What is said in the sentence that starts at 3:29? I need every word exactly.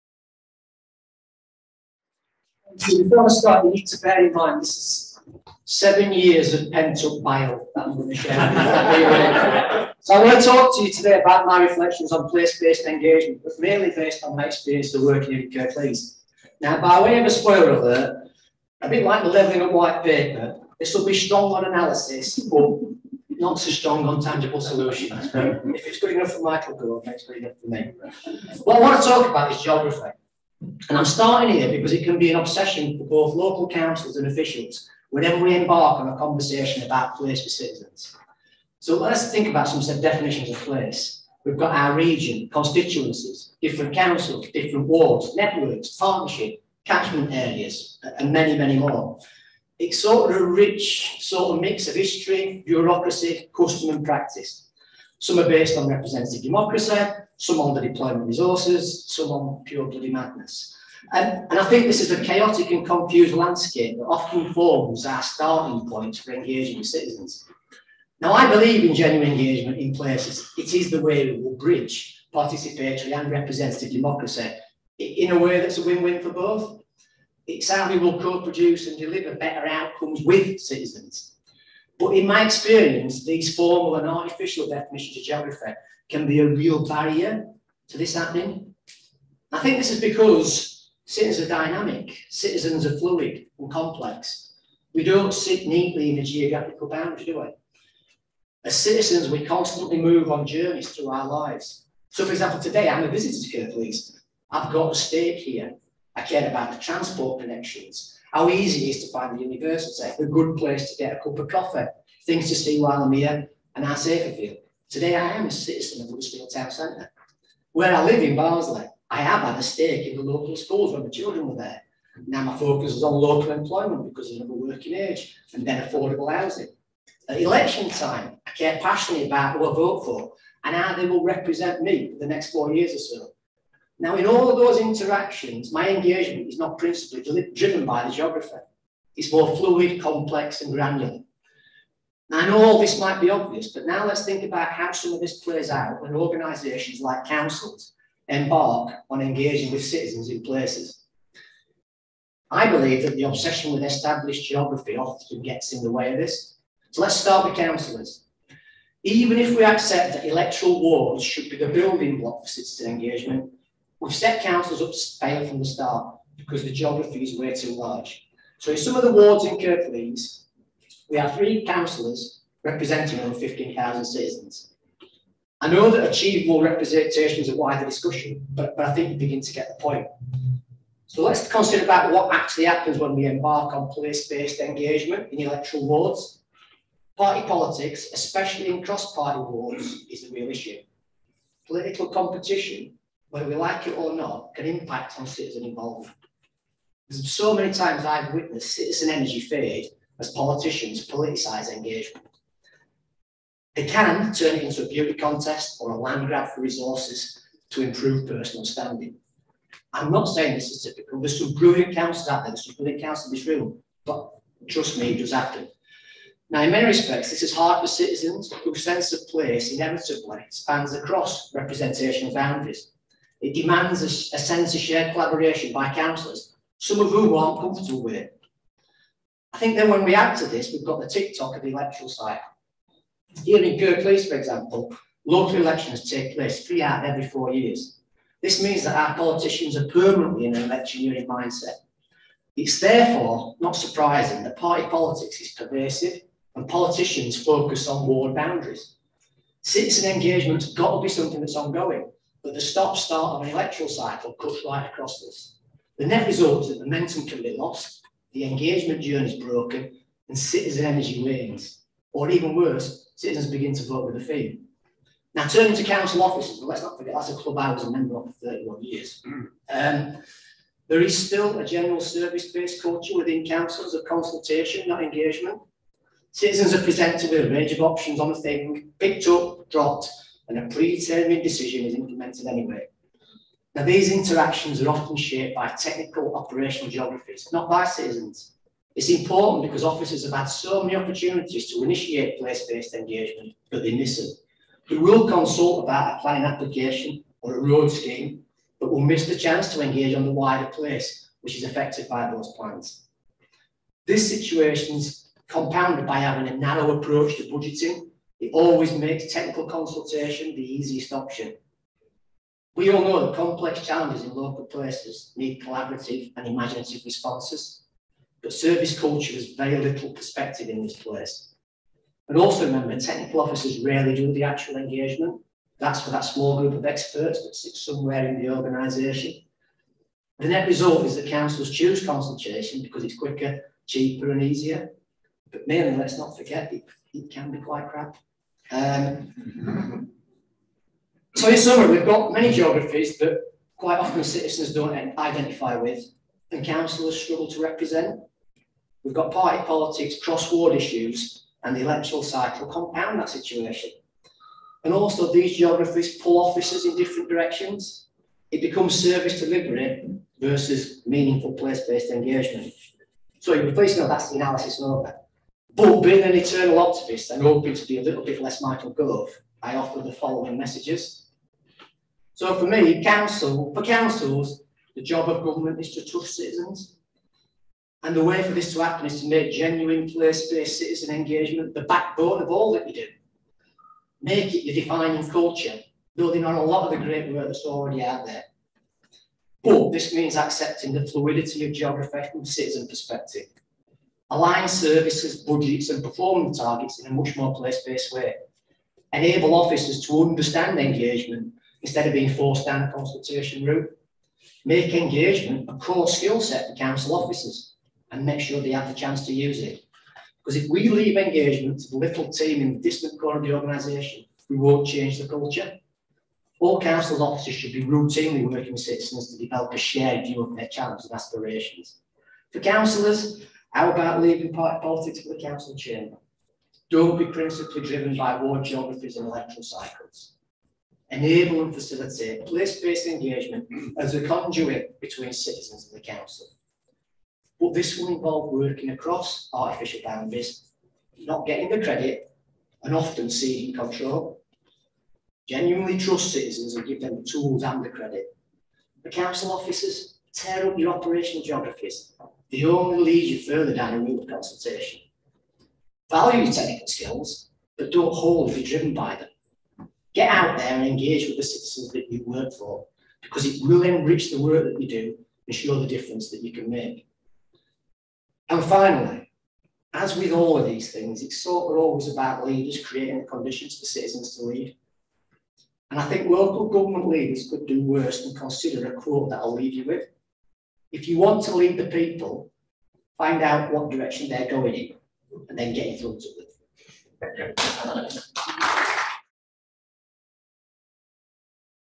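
I'm not saying this is typical.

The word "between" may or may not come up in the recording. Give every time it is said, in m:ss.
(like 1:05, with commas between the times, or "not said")
7:14.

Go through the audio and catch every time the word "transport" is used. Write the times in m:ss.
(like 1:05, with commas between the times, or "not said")
1:46.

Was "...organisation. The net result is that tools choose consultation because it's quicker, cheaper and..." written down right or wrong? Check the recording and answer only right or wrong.
wrong.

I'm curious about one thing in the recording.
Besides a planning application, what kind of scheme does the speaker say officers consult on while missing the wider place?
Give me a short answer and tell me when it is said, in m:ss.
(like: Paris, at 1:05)
road scheme, at 4:57.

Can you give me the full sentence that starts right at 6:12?
So for me, council, for councils, the job of government is to trust citizens.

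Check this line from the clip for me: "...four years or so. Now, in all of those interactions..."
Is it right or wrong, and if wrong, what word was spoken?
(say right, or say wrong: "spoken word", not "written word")
right.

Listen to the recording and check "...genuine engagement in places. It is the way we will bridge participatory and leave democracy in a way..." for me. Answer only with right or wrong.
wrong.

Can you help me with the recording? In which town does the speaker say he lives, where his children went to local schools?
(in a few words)
Barnsley.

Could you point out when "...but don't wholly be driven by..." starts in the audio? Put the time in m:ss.
7:37.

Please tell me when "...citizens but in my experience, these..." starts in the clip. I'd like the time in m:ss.
1:20.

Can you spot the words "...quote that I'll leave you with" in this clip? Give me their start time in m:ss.
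7:58.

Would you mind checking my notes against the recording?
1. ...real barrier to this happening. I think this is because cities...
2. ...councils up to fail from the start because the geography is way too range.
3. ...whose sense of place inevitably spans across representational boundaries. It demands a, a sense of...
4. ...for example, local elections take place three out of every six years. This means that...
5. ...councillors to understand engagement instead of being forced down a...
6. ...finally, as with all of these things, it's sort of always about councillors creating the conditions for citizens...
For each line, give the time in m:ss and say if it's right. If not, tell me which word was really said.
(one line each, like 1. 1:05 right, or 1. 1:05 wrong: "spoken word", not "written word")
1. 1:26 right
2. 2:44 wrong: "large", not "range"
3. 3:38 right
4. 3:54 wrong: "four", not "six"
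5. 6:39 wrong: "officers", not "councillors"
6. 7:48 wrong: "leaders", not "councillors".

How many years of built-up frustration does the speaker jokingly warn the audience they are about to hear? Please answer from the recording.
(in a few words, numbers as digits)
7.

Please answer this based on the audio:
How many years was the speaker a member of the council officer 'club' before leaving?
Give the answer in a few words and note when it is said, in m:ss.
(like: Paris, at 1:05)
31, at 4:28.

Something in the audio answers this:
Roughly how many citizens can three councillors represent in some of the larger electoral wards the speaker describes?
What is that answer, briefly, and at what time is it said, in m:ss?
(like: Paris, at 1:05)
over 15,000, at 2:53.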